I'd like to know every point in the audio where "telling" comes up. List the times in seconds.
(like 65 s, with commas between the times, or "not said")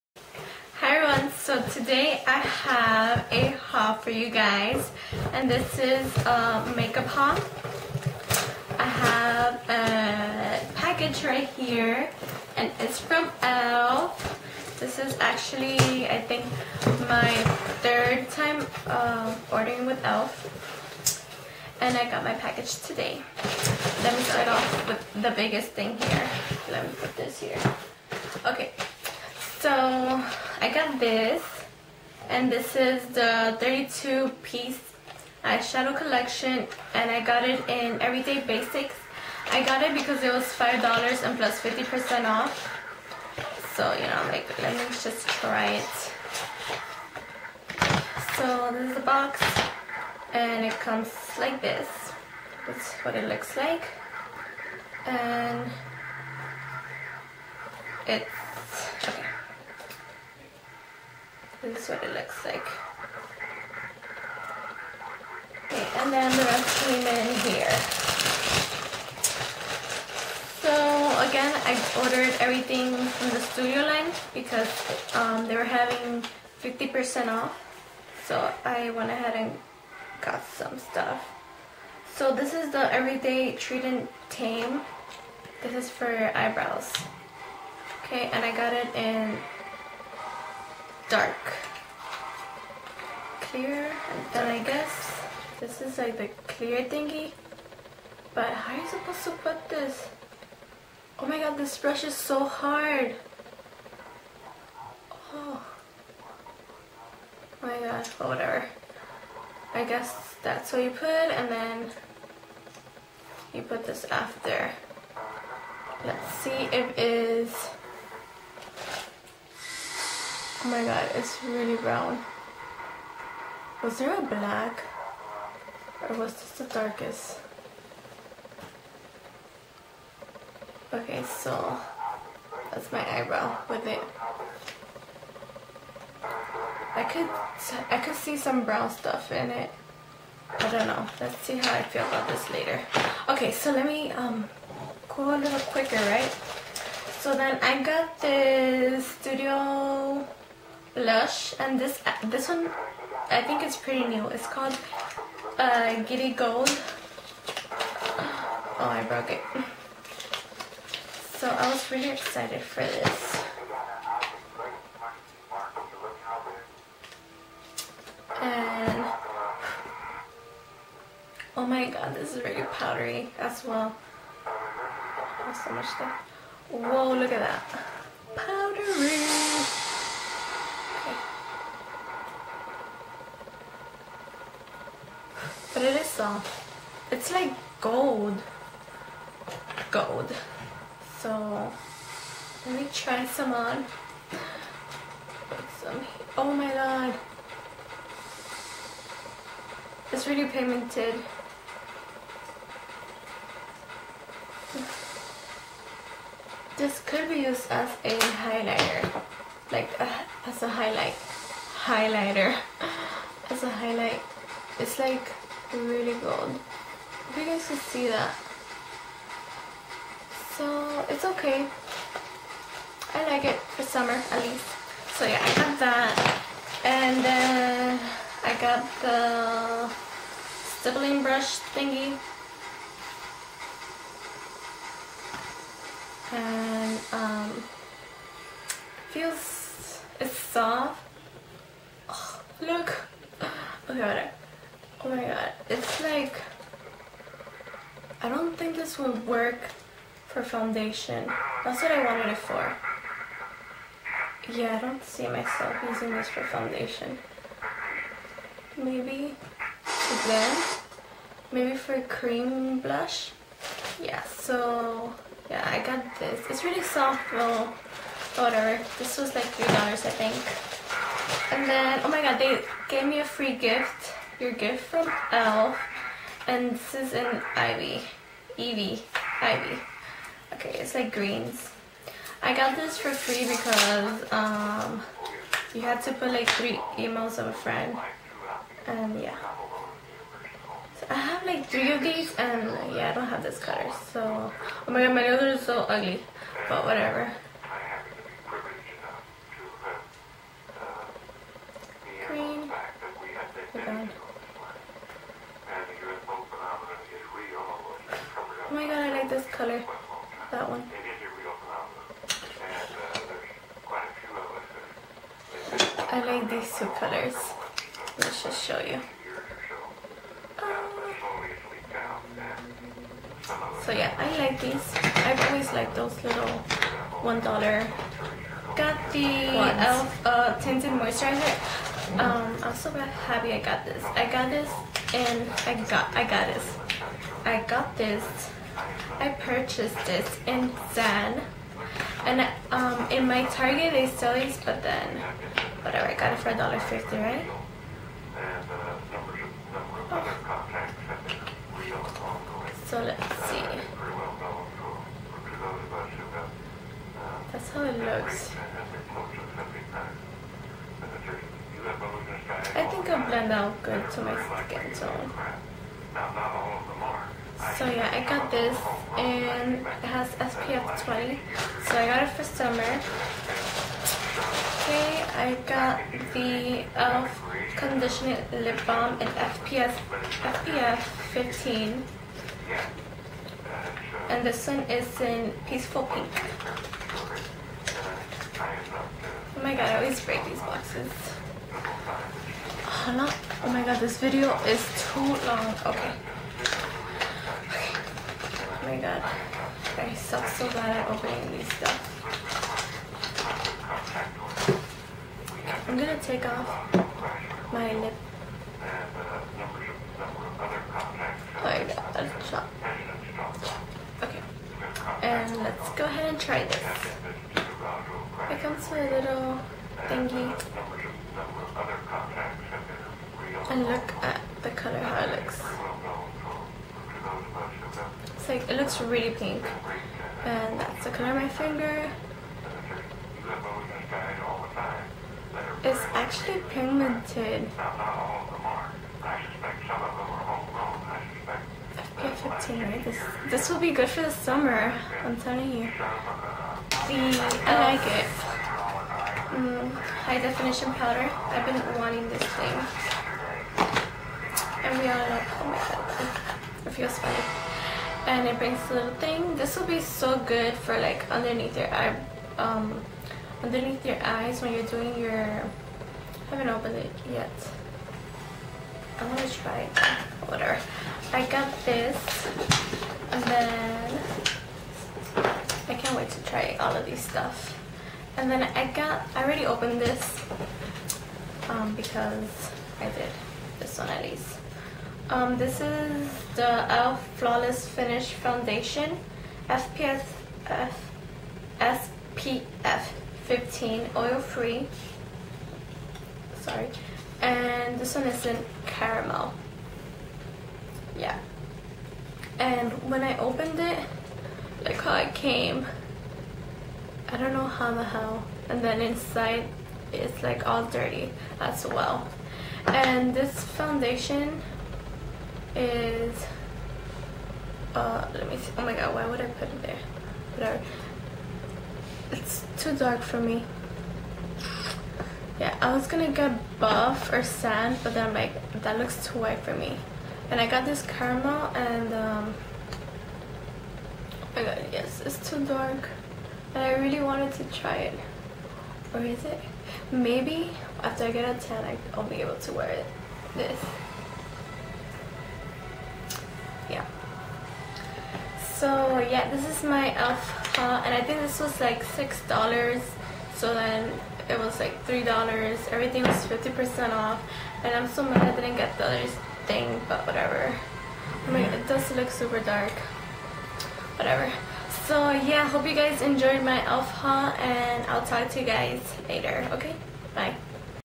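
445 s.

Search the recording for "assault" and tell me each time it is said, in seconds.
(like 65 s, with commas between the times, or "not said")
not said.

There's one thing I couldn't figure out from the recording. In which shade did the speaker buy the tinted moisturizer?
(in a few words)
Zen.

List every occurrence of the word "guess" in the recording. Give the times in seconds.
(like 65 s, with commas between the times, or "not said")
94 s, 109 s.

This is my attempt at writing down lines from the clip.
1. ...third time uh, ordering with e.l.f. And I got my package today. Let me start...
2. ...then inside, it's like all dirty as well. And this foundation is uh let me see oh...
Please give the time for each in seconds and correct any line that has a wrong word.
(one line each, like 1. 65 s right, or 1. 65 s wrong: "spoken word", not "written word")
1. 17 s right
2. 508 s right.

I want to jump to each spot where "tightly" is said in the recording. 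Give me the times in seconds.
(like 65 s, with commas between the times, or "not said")
not said.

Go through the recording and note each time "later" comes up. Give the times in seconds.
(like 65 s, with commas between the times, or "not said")
142 s, 569 s.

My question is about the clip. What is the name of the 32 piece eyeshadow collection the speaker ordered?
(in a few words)
Everyday Basics.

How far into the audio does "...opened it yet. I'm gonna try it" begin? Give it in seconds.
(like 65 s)
466 s.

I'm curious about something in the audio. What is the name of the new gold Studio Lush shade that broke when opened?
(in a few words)
Giddy Gold.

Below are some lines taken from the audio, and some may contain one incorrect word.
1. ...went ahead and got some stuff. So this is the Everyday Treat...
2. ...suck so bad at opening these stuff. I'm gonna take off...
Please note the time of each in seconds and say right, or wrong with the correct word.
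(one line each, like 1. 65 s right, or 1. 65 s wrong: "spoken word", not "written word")
1. 78 s right
2. 400 s right.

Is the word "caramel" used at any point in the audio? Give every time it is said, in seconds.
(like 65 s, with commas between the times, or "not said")
498 s, 531 s.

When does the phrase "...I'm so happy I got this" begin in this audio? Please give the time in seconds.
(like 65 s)
332 s.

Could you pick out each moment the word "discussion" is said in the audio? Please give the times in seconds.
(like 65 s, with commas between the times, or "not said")
not said.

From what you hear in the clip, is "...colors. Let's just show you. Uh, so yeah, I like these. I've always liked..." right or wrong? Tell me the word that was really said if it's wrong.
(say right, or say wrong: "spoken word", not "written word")
right.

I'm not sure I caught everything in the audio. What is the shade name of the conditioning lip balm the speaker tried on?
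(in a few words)
Peaceful Pink.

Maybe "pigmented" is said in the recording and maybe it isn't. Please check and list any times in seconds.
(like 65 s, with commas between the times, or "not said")
200 s, 436 s.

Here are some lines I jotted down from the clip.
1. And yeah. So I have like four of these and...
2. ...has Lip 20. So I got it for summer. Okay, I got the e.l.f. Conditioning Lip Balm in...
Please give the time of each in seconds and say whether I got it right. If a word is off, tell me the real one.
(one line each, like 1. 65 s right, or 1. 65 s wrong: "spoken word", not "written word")
1. 288 s wrong: "three", not "four"
2. 370 s wrong: "SPF", not "Lip".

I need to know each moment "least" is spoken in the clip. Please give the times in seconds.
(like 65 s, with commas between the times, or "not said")
224 s, 484 s.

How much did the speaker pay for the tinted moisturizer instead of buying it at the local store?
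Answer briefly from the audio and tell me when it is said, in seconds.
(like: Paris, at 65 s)
$1.50, at 346 s.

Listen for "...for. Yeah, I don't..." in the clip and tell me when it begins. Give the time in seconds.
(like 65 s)
252 s.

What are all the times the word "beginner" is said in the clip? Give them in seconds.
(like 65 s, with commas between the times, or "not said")
not said.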